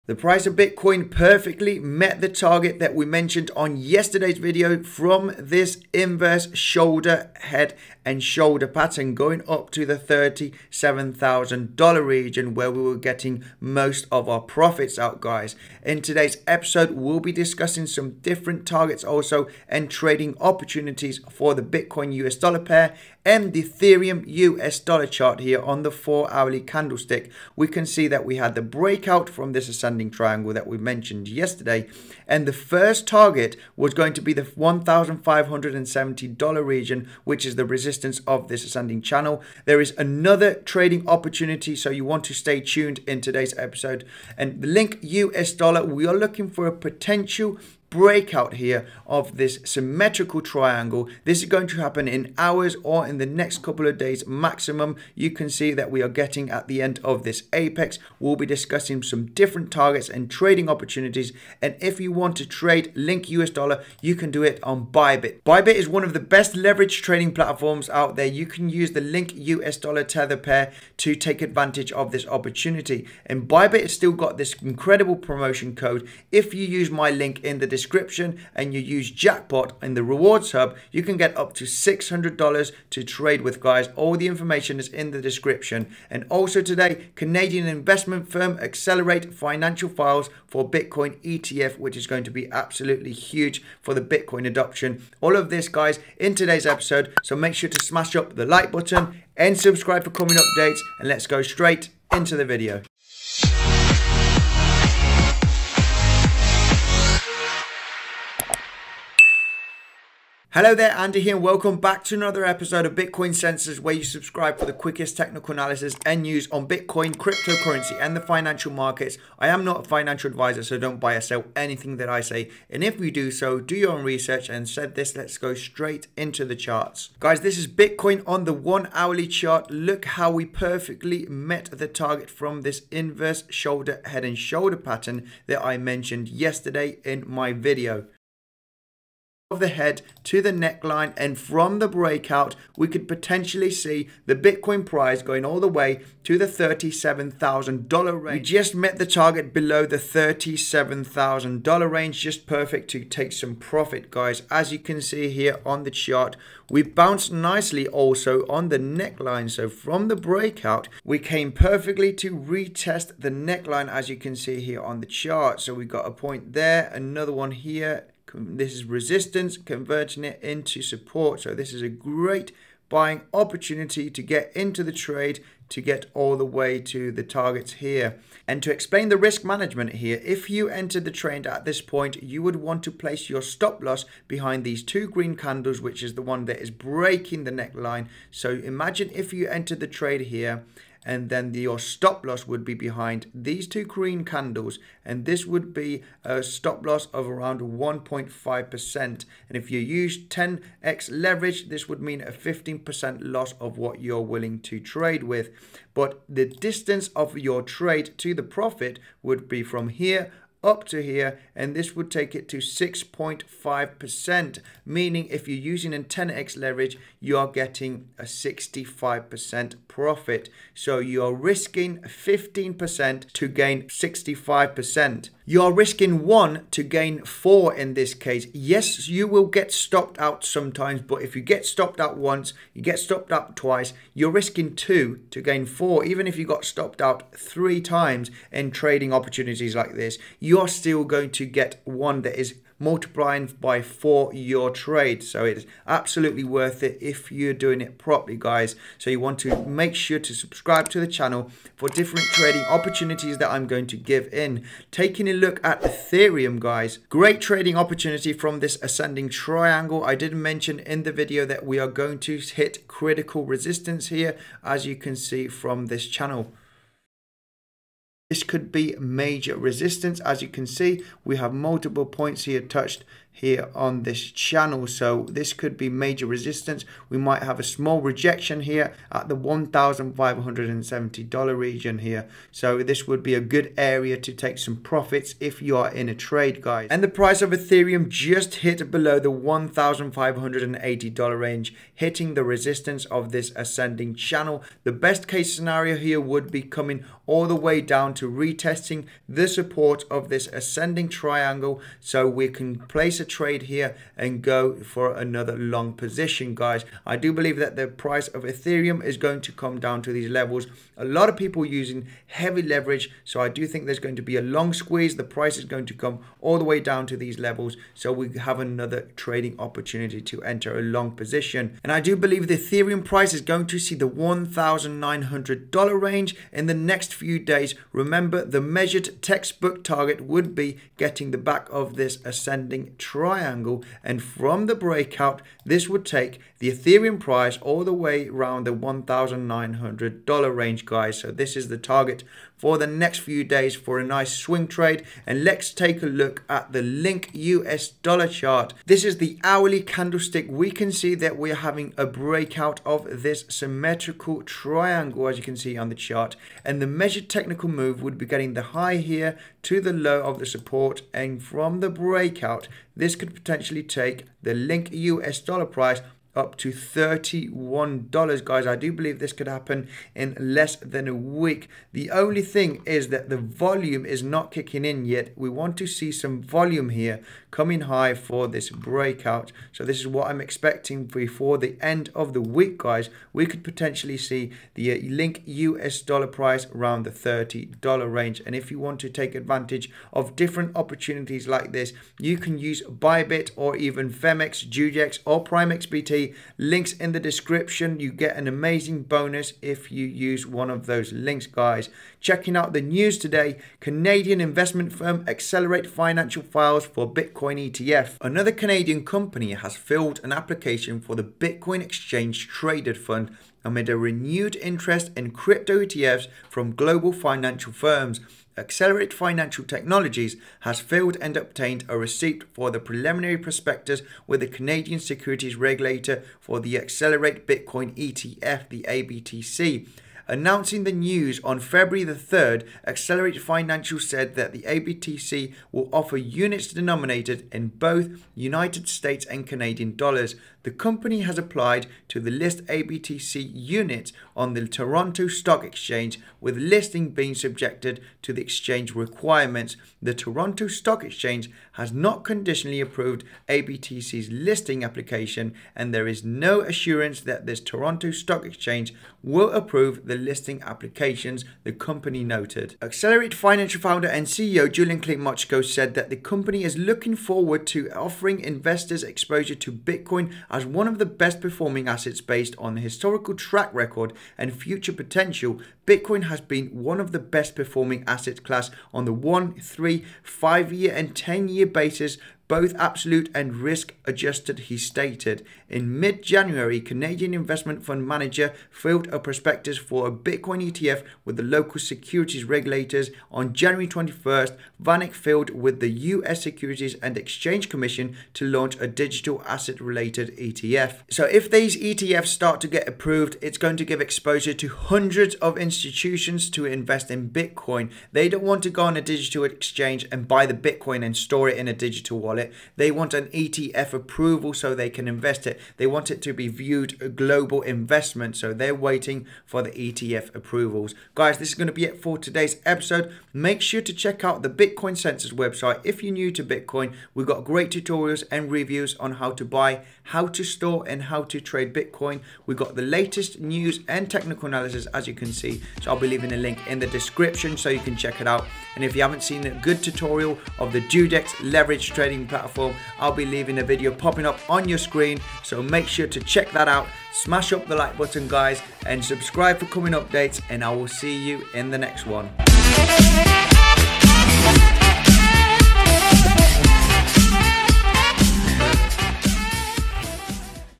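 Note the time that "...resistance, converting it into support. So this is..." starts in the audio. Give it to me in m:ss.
2:48.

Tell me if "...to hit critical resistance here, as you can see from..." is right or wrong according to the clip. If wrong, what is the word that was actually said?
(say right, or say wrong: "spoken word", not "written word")
right.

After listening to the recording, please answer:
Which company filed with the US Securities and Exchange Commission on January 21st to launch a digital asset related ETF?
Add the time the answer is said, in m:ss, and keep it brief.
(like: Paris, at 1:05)
VanEck, at 8:14.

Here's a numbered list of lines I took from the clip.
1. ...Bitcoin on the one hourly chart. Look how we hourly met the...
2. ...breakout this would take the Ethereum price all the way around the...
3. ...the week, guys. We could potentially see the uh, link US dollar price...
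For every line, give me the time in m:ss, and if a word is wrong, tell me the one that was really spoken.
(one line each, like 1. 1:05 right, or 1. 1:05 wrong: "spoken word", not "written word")
1. 2:07 wrong: "perfectly", not "hourly"
2. 5:34 right
3. 6:22 right.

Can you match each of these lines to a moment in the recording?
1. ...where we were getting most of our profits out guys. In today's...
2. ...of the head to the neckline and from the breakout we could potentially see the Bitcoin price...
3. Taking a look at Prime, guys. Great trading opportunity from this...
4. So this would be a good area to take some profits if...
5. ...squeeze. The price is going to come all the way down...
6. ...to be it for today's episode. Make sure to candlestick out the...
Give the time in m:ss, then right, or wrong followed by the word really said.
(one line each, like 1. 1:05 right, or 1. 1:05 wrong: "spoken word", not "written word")
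1. 0:12 right
2. 2:19 right
3. 4:14 wrong: "Ethereum", not "Prime"
4. 4:42 right
5. 5:14 right
6. 8:41 wrong: "check", not "candlestick".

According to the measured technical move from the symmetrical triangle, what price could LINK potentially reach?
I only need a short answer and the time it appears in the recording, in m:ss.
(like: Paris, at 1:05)
$31, at 6:06.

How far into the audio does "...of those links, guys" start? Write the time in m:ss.
6:40.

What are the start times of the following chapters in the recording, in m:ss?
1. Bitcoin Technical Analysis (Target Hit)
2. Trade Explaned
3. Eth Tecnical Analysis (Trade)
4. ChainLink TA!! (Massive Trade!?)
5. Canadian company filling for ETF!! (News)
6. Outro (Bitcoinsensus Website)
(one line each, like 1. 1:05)
1. 2:07
2. 3:10
3. 4:18
4. 5:46
5. 6:44
6. 8:41.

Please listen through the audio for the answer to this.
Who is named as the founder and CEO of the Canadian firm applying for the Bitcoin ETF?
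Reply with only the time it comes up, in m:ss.
7:44.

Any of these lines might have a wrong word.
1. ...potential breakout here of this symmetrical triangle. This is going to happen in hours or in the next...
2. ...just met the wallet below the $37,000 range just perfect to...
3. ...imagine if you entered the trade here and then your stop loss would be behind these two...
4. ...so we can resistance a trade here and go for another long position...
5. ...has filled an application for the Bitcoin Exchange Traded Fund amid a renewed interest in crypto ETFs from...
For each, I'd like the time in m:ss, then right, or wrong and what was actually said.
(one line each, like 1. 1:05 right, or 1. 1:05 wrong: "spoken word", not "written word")
1. 0:46 right
2. 2:28 wrong: "target", not "wallet"
3. 3:08 right
4. 5:01 wrong: "place", not "resistance"
5. 6:49 right.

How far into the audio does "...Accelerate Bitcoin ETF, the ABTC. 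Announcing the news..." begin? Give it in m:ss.
7:06.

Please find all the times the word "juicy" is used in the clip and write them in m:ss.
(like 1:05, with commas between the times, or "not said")
not said.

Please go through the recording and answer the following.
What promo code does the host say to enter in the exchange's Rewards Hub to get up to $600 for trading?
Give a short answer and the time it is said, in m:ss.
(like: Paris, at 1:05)
Jackpot, at 1:19.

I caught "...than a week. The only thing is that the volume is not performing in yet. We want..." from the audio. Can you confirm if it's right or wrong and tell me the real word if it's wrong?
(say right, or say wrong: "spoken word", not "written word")
wrong: "kicking", not "performing".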